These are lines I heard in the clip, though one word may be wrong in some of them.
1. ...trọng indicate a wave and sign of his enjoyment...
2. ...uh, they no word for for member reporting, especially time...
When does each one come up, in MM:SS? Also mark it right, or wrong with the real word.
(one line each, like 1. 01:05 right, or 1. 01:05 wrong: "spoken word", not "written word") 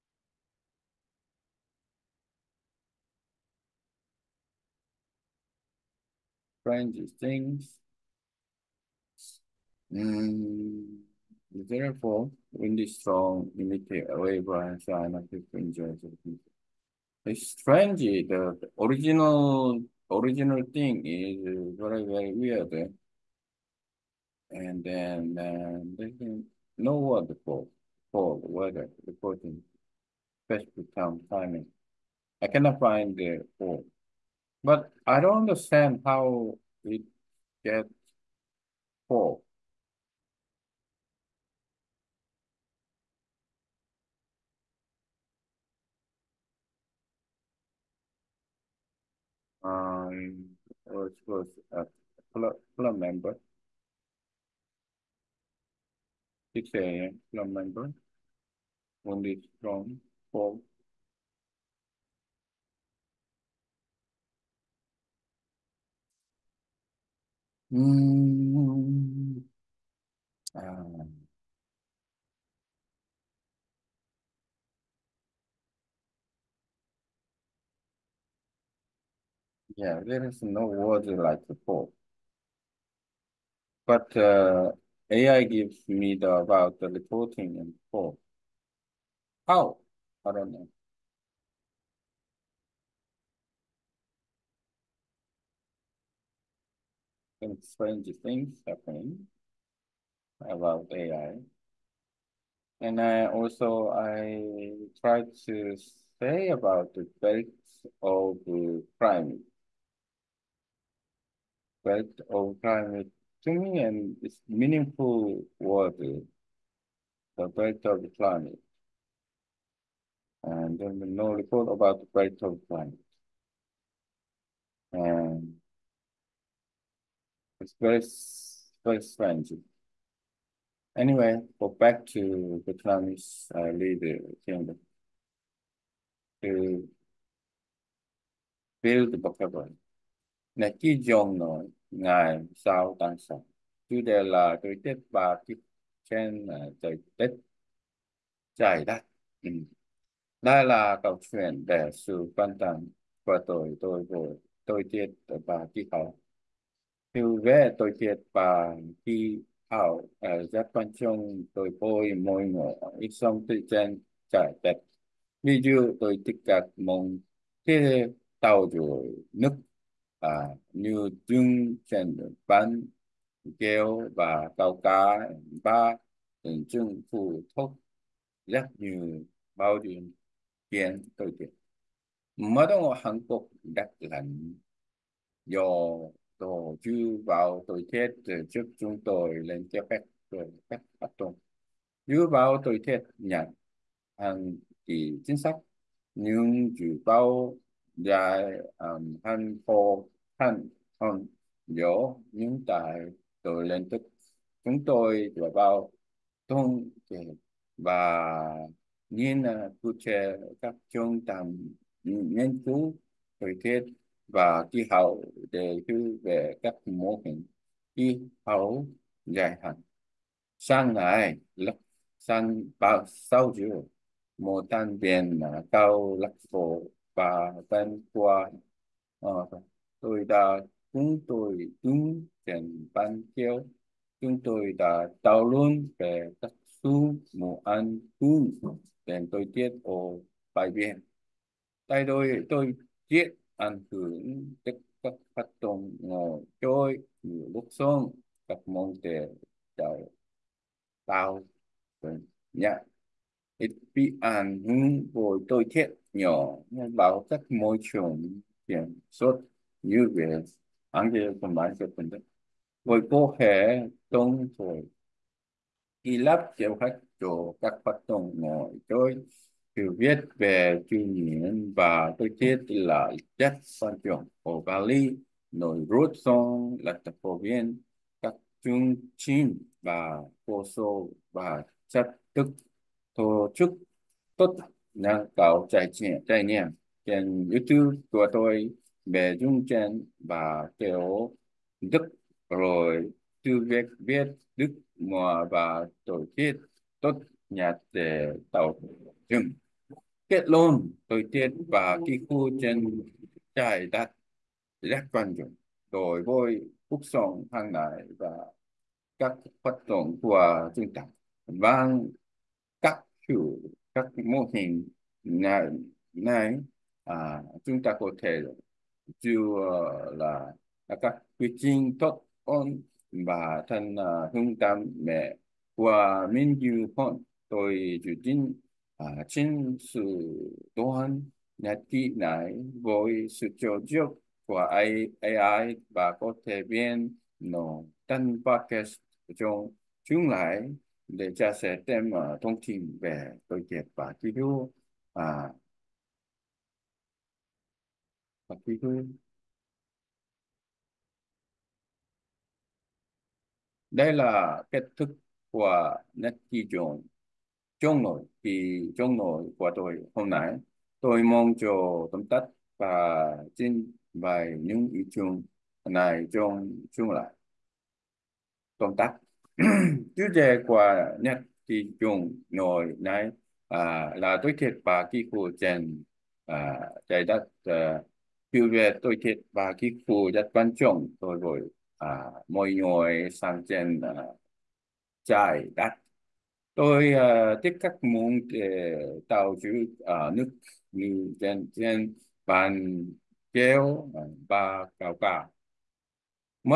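1. 00:12 wrong: "strong", not "trọng"
2. 00:25 wrong: "weather", not "member".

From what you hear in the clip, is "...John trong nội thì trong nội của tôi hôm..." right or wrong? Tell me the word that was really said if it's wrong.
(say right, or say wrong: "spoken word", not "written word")
right.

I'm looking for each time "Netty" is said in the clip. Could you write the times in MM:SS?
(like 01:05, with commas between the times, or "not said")
05:56, 06:11.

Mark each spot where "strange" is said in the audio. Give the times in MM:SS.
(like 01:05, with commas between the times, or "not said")
00:06, 00:17, 01:37, 02:09.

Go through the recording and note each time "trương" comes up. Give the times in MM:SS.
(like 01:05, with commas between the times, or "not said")
02:51, 02:56.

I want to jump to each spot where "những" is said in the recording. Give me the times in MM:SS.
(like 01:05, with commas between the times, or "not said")
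03:22, 06:04.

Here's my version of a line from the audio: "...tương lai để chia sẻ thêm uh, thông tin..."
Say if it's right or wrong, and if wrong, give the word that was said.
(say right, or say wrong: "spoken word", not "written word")
right.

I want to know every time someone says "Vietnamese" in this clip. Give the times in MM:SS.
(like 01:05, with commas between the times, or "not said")
02:12.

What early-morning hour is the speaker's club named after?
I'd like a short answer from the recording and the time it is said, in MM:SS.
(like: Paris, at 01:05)
6 a.m., at 00:56.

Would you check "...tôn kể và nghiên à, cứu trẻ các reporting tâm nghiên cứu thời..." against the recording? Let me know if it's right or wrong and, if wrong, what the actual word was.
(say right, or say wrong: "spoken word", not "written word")
wrong: "trung", not "reporting".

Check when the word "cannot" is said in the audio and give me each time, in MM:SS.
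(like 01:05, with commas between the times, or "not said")
00:32.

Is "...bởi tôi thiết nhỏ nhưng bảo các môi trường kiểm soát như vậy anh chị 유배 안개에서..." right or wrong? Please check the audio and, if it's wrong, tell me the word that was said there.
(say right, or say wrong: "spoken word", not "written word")
right.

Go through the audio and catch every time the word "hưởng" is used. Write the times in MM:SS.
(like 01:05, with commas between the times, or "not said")
04:03, 04:14.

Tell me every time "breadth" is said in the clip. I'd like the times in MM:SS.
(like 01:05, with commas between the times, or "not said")
01:57, 02:02.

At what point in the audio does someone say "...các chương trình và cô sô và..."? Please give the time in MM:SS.
04:38.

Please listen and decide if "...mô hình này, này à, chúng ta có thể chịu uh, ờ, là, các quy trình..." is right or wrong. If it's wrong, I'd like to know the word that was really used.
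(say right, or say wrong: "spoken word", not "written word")
right.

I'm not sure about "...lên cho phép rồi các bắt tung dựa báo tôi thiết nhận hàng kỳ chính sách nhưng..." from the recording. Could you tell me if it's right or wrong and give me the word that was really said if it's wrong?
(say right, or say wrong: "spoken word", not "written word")
right.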